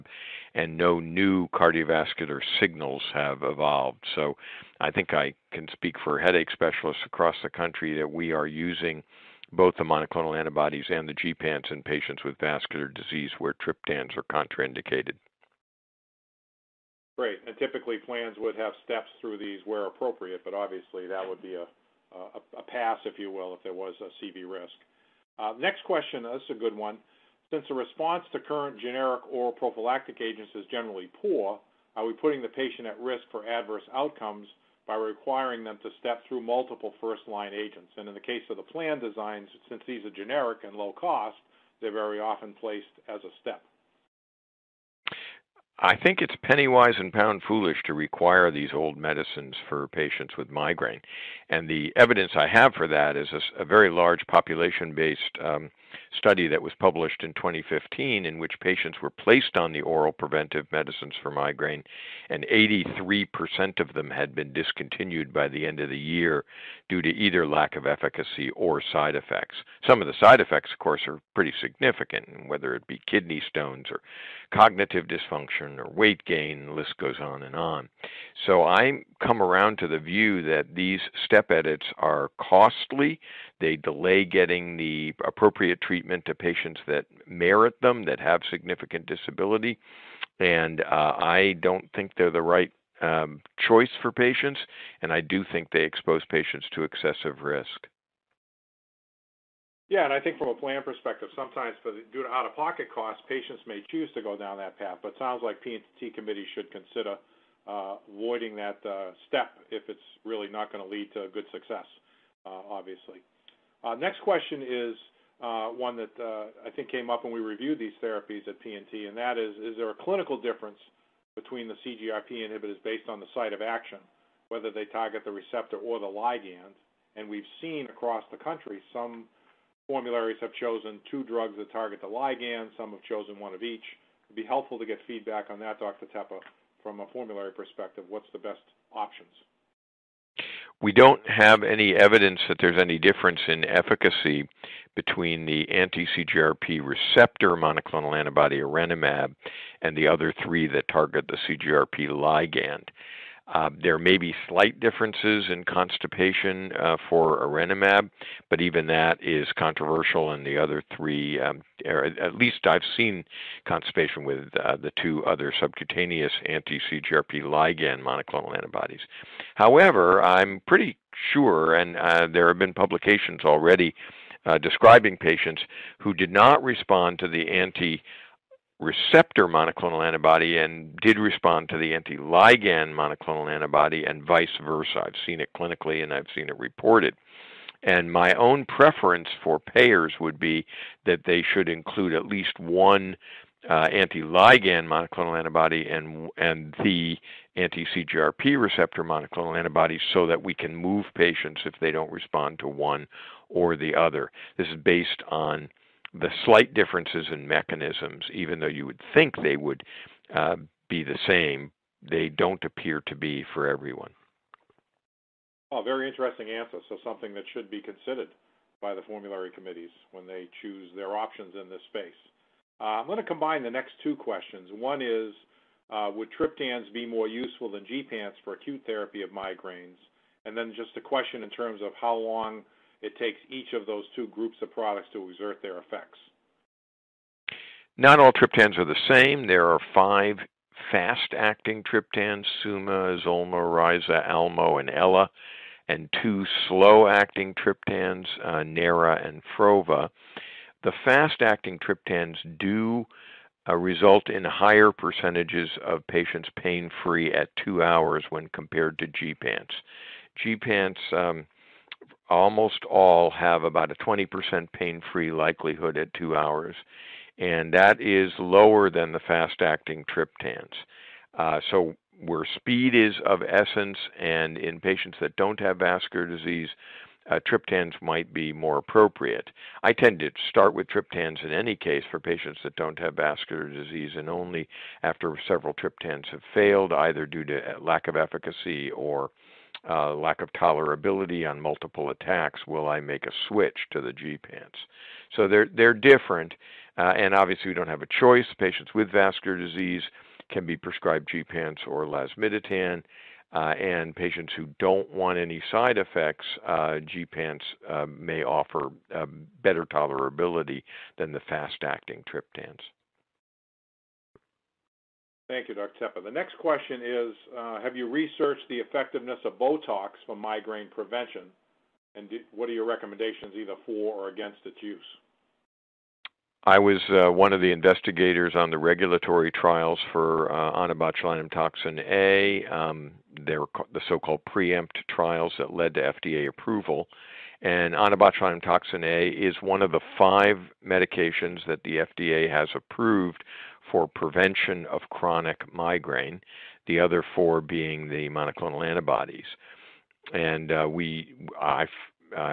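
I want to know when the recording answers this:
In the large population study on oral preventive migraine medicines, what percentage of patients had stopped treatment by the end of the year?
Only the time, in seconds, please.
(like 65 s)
62 s.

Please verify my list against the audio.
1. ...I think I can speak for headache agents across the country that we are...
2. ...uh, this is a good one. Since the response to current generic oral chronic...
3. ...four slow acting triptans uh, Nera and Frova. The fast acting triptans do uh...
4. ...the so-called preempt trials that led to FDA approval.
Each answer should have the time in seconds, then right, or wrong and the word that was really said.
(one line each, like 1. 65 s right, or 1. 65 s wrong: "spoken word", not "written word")
1. 4 s wrong: "specialists", not "agents"
2. 26 s wrong: "prophylactic", not "chronic"
3. 246 s wrong: "two", not "four"
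4. 333 s right.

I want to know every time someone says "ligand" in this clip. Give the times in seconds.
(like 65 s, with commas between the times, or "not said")
126 s, 132 s, 152 s, 167 s, 182 s, 193 s.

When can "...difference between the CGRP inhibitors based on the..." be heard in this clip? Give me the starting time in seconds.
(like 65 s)
120 s.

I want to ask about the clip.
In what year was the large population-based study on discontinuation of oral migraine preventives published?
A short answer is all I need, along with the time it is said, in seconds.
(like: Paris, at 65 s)
2015, at 57 s.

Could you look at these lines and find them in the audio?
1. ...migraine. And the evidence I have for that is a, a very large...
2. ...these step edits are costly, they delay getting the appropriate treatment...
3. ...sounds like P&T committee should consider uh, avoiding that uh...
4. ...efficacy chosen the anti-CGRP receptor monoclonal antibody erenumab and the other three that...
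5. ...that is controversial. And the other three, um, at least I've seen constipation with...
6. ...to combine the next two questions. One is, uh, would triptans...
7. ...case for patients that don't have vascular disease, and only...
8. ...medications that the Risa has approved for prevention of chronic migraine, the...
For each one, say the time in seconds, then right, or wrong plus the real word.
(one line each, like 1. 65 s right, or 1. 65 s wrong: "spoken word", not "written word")
1. 50 s right
2. 80 s right
3. 105 s right
4. 143 s wrong: "between", not "chosen"
5. 158 s right
6. 223 s right
7. 281 s right
8. 340 s wrong: "FDA", not "Risa".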